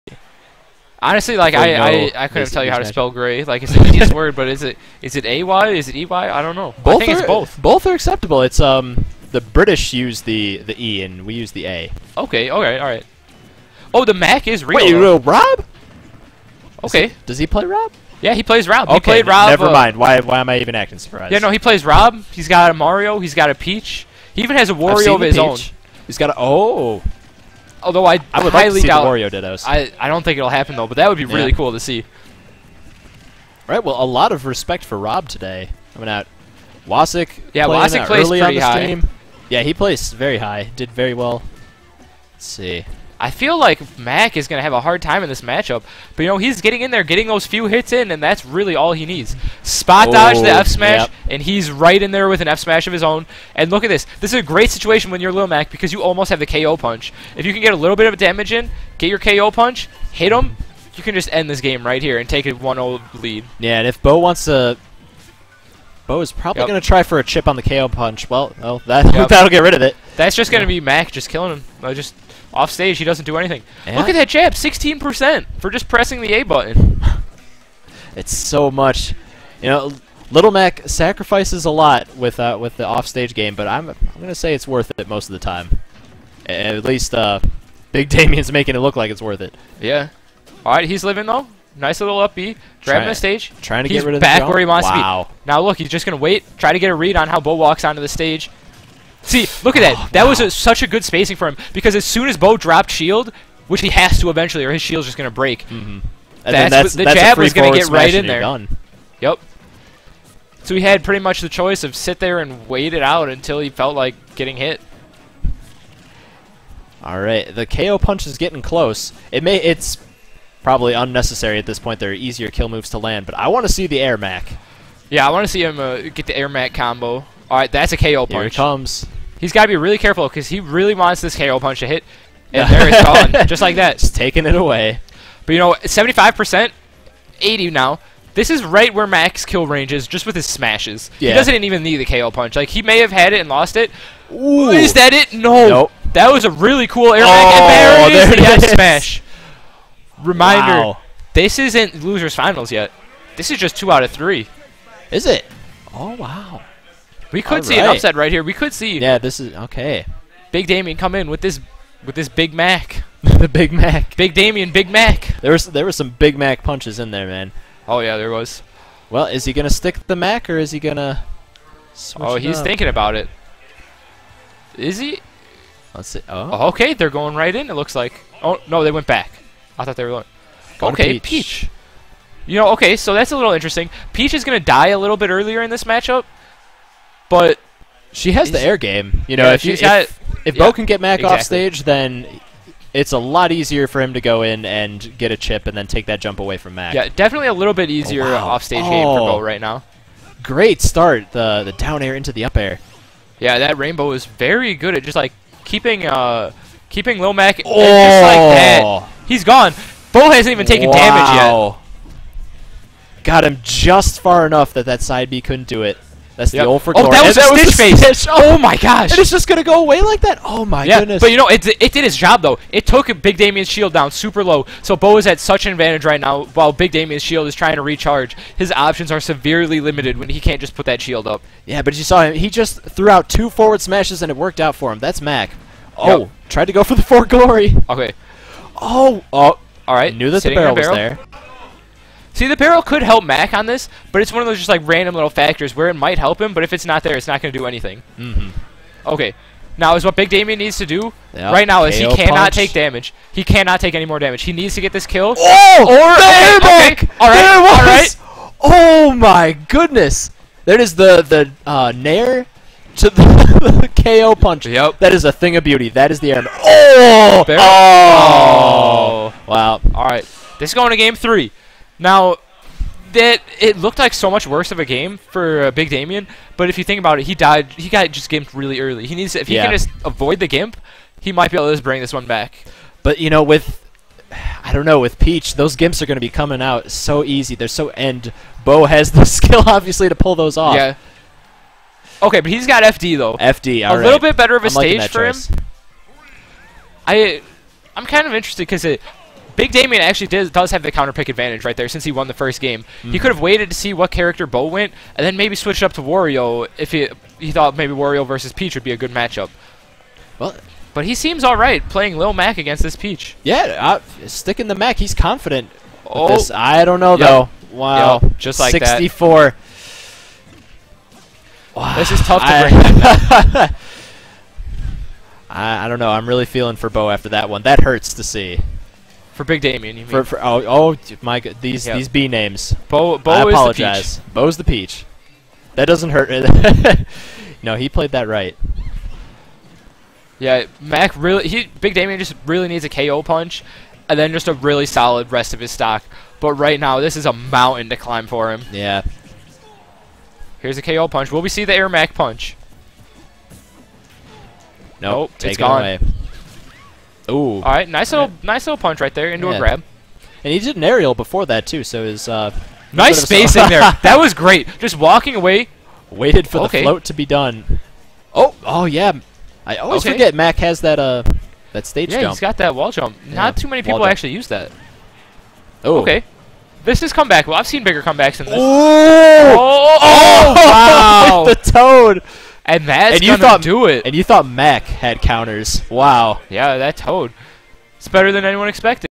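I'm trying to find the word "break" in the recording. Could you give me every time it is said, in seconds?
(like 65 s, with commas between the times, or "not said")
105 s, 323 s.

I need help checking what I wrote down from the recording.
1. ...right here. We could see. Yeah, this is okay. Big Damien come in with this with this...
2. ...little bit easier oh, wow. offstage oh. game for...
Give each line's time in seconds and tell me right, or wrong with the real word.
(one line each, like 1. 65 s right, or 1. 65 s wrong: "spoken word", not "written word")
1. 158 s right
2. 197 s right.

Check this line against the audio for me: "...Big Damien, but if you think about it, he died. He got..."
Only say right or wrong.
right.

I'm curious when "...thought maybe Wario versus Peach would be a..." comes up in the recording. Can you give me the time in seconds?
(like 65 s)
307 s.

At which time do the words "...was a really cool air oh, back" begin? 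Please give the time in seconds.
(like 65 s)
146 s.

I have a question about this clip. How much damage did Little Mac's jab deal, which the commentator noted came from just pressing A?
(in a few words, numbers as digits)
16%.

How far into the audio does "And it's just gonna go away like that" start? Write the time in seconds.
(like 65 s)
219 s.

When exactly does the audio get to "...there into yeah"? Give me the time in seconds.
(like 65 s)
359 s.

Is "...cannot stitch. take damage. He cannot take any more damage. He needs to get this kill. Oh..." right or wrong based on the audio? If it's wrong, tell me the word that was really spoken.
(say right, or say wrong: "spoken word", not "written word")
wrong: "punch", not "stitch".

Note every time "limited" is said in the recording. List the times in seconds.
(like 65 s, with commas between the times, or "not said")
229 s.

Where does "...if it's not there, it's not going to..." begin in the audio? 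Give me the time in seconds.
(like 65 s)
246 s.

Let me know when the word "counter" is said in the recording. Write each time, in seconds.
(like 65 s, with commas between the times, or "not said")
300 s, 385 s.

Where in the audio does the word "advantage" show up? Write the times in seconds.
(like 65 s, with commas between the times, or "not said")
225 s, 301 s.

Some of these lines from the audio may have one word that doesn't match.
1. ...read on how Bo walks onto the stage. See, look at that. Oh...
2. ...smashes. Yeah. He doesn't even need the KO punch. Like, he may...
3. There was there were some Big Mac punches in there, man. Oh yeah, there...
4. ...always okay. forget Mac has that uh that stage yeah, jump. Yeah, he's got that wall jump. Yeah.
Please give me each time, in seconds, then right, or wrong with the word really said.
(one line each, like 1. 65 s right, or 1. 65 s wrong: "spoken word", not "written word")
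1. 96 s right
2. 140 s right
3. 165 s right
4. 369 s right.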